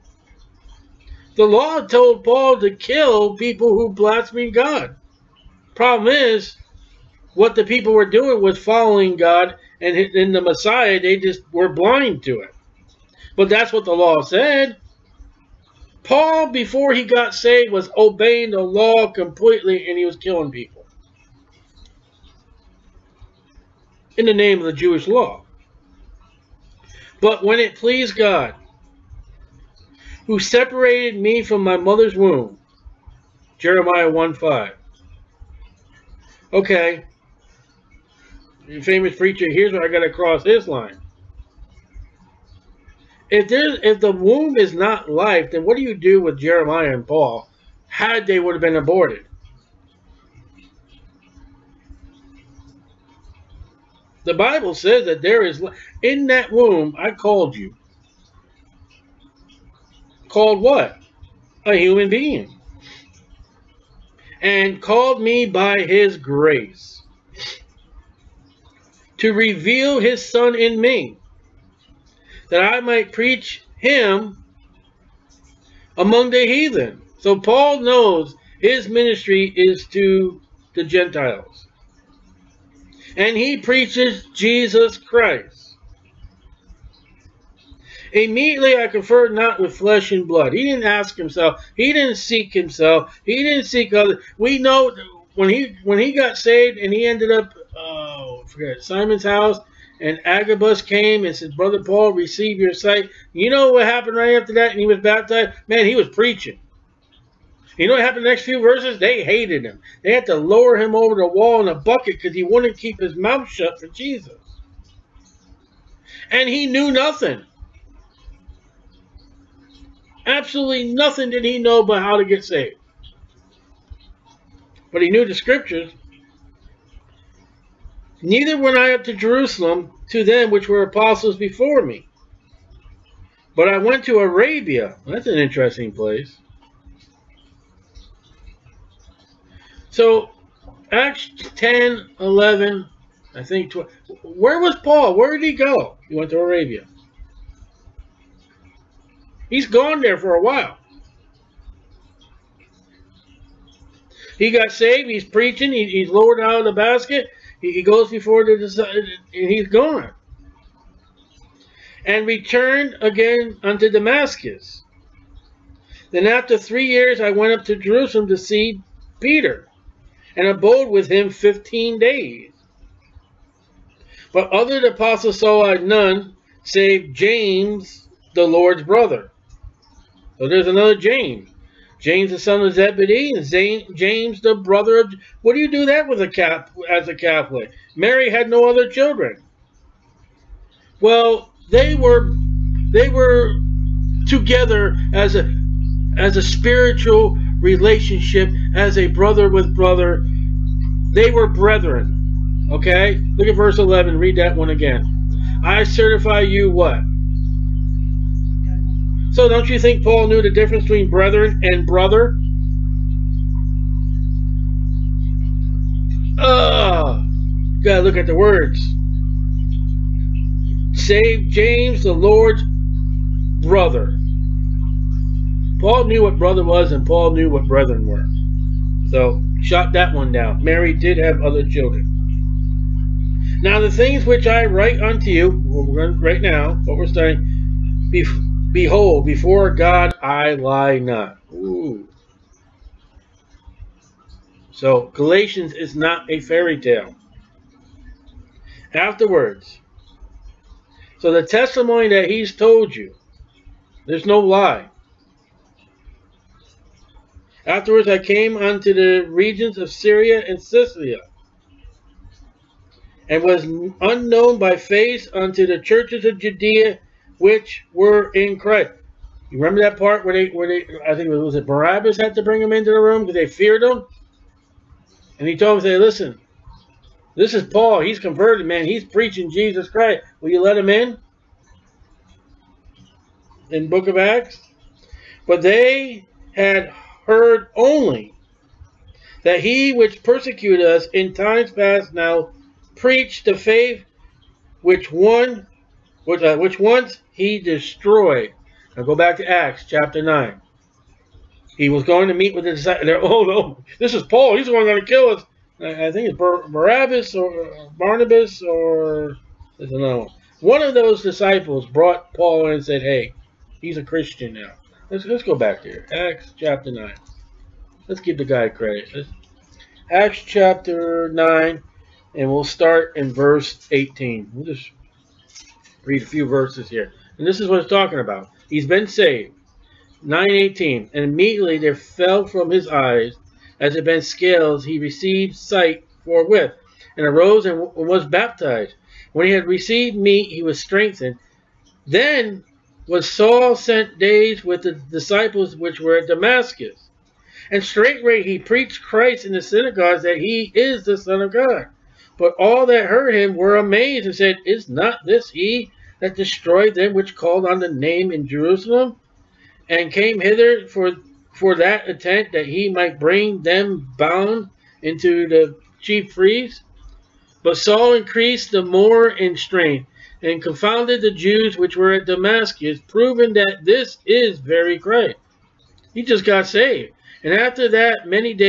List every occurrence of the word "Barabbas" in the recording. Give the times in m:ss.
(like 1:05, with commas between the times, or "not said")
4:31, 5:06.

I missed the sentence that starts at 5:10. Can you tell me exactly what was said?
One of those disciples brought Paul in and said, hey, he's a Christian now.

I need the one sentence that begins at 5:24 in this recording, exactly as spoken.
We'll just read a few verses here.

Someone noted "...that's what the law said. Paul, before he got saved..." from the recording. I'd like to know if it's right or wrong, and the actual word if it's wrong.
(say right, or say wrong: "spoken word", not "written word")
right.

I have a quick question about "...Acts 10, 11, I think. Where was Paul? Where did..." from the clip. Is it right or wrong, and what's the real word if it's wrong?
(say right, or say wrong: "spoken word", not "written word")
right.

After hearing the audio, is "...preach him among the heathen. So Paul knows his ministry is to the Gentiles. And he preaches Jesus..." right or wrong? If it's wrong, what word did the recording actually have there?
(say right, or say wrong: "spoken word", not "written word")
right.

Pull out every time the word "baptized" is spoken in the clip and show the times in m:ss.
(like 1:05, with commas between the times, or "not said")
1:44, 5:38.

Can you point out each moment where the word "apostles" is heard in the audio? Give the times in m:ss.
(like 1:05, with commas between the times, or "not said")
2:10, 2:54.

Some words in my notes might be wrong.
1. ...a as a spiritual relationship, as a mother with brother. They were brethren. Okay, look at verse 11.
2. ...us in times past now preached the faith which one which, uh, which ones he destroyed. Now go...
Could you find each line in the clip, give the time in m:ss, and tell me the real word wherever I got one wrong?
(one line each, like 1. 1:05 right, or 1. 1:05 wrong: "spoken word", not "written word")
1. 3:15 wrong: "brother", not "mother"
2. 4:50 right.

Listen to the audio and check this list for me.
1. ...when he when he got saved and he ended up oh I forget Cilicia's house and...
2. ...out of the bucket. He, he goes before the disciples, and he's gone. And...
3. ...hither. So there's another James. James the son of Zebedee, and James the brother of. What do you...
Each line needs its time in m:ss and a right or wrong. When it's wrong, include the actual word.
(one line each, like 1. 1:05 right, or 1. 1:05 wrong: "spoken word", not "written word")
1. 1:35 wrong: "Simon", not "Cilicia"
2. 2:36 wrong: "basket", not "bucket"
3. 2:58 wrong: "brother", not "hither".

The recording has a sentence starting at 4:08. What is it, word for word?
Afterwards, so the testimony that he's told you, there's no lie.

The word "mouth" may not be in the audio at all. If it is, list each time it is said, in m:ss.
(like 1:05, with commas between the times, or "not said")
1:53.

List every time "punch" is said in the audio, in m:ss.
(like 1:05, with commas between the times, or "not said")
not said.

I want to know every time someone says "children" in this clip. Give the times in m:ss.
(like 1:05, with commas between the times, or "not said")
3:08, 3:51.